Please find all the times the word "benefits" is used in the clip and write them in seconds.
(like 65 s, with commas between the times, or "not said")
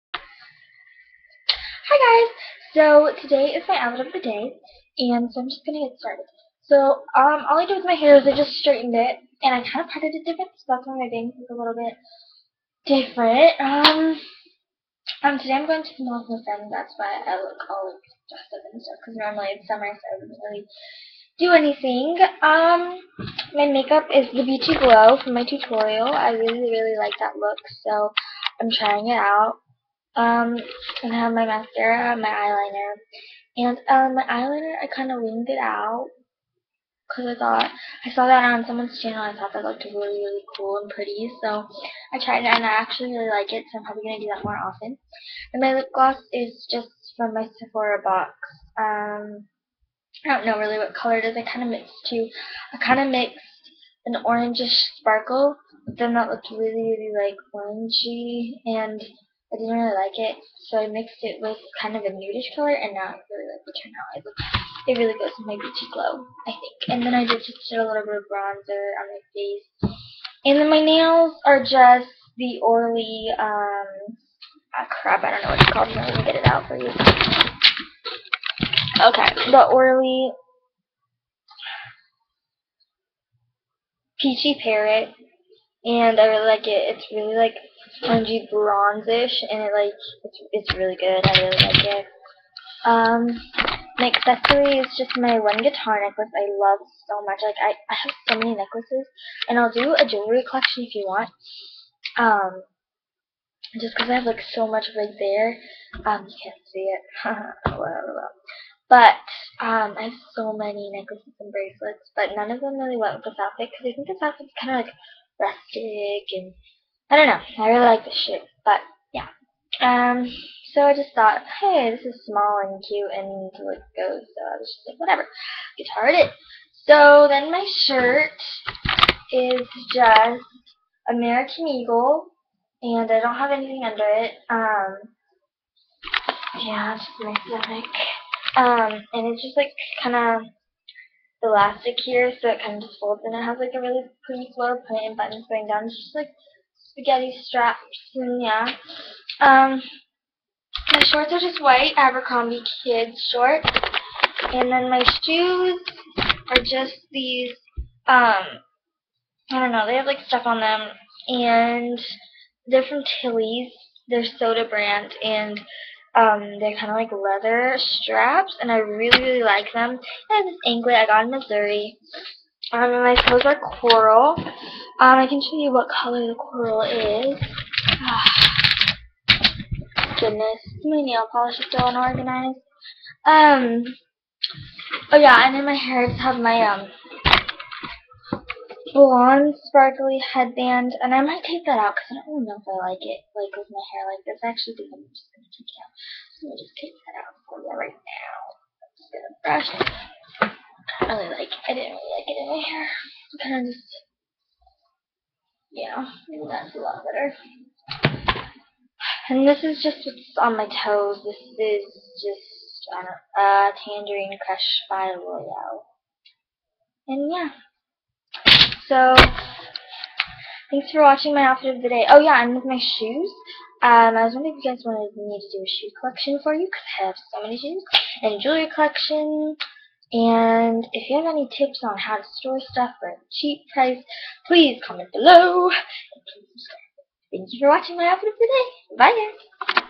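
not said.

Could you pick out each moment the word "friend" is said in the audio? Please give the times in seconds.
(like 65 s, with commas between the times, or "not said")
16 s.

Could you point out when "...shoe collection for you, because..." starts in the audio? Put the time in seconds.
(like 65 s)
225 s.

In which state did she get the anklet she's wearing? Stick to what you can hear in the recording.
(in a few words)
Missouri.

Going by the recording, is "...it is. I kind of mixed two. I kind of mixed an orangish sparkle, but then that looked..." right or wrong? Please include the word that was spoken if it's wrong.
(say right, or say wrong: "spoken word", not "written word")
right.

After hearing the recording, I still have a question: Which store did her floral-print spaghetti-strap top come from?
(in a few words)
American Eagle.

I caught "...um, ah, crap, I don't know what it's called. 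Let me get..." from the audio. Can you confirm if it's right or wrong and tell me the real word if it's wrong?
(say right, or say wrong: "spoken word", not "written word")
right.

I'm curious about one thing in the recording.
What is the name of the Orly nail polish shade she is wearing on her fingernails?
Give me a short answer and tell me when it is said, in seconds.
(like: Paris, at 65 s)
Peachy Parrot, at 84 s.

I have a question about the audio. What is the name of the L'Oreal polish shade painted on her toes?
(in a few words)
Tangerine Crush.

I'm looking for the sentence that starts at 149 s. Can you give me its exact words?
Um, my shorts are just white Abercrombie kids shorts, and then my shoes are just these.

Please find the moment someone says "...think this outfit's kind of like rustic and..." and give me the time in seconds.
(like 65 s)
113 s.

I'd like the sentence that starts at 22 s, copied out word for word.
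Um, my makeup is the Beauty Glow from my tutorial.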